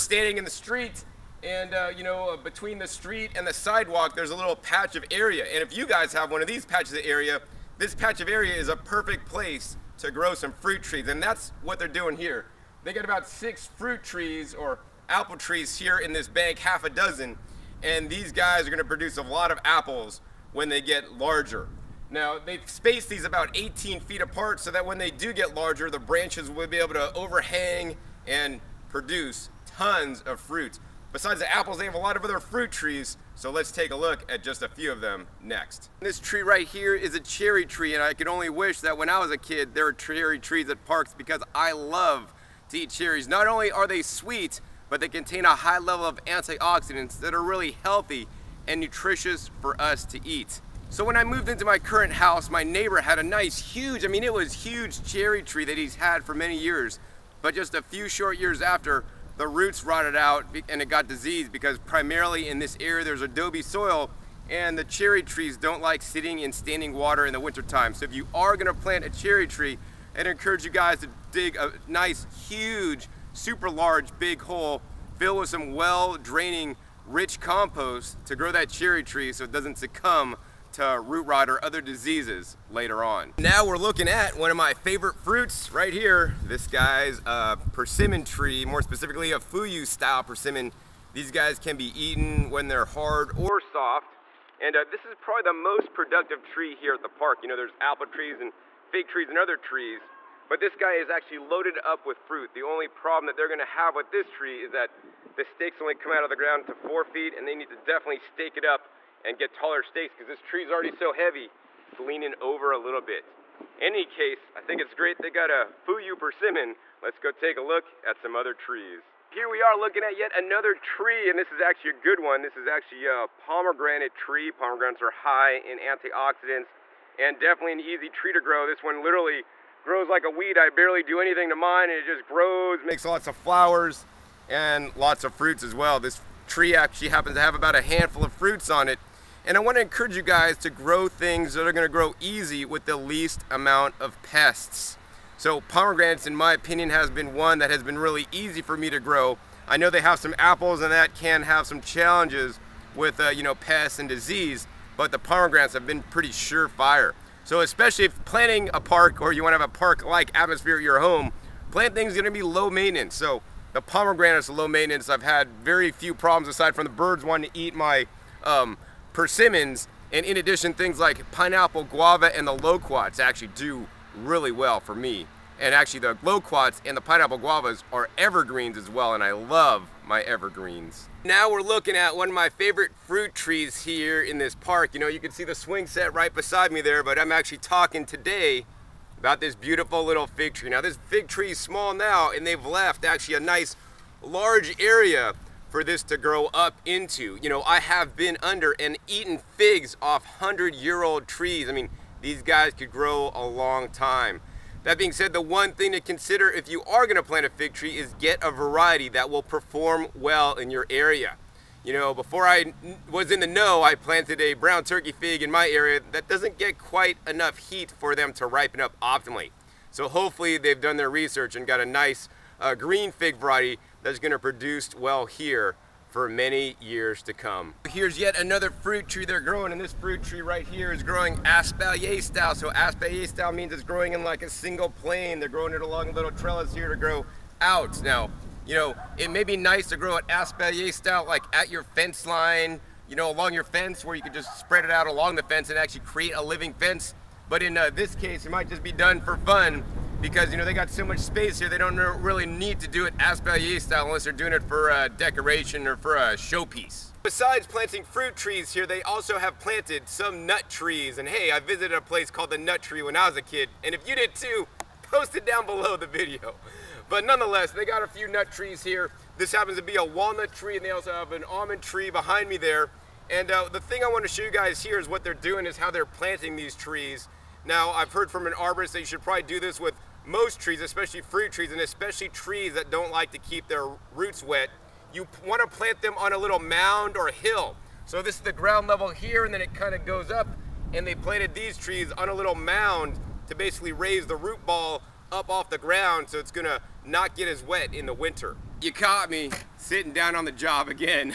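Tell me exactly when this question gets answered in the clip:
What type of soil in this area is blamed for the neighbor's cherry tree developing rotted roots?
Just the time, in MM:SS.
01:03.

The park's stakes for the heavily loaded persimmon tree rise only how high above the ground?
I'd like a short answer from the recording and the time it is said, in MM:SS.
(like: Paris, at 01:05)
4 feet, at 01:46.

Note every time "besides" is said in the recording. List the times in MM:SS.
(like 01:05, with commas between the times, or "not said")
00:31, 03:06, 04:17.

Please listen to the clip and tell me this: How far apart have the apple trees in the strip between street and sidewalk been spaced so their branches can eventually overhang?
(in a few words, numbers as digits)
18 feet.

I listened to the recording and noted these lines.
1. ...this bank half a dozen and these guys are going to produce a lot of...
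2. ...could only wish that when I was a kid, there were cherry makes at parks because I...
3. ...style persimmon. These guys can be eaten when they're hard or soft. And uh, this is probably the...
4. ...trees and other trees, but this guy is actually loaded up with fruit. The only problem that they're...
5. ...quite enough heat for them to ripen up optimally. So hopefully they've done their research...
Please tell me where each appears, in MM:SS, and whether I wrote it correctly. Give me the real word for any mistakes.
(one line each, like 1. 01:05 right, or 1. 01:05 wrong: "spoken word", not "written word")
1. 00:16 right
2. 00:38 wrong: "trees", not "makes"
3. 01:29 right
4. 01:39 right
5. 03:36 right.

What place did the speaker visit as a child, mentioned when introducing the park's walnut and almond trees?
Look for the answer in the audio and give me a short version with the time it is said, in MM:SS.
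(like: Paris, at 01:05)
the Nut Tree, at 04:22.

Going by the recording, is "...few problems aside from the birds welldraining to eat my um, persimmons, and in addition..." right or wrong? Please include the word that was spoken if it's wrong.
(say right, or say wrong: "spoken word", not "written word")
wrong: "wanting", not "welldraining".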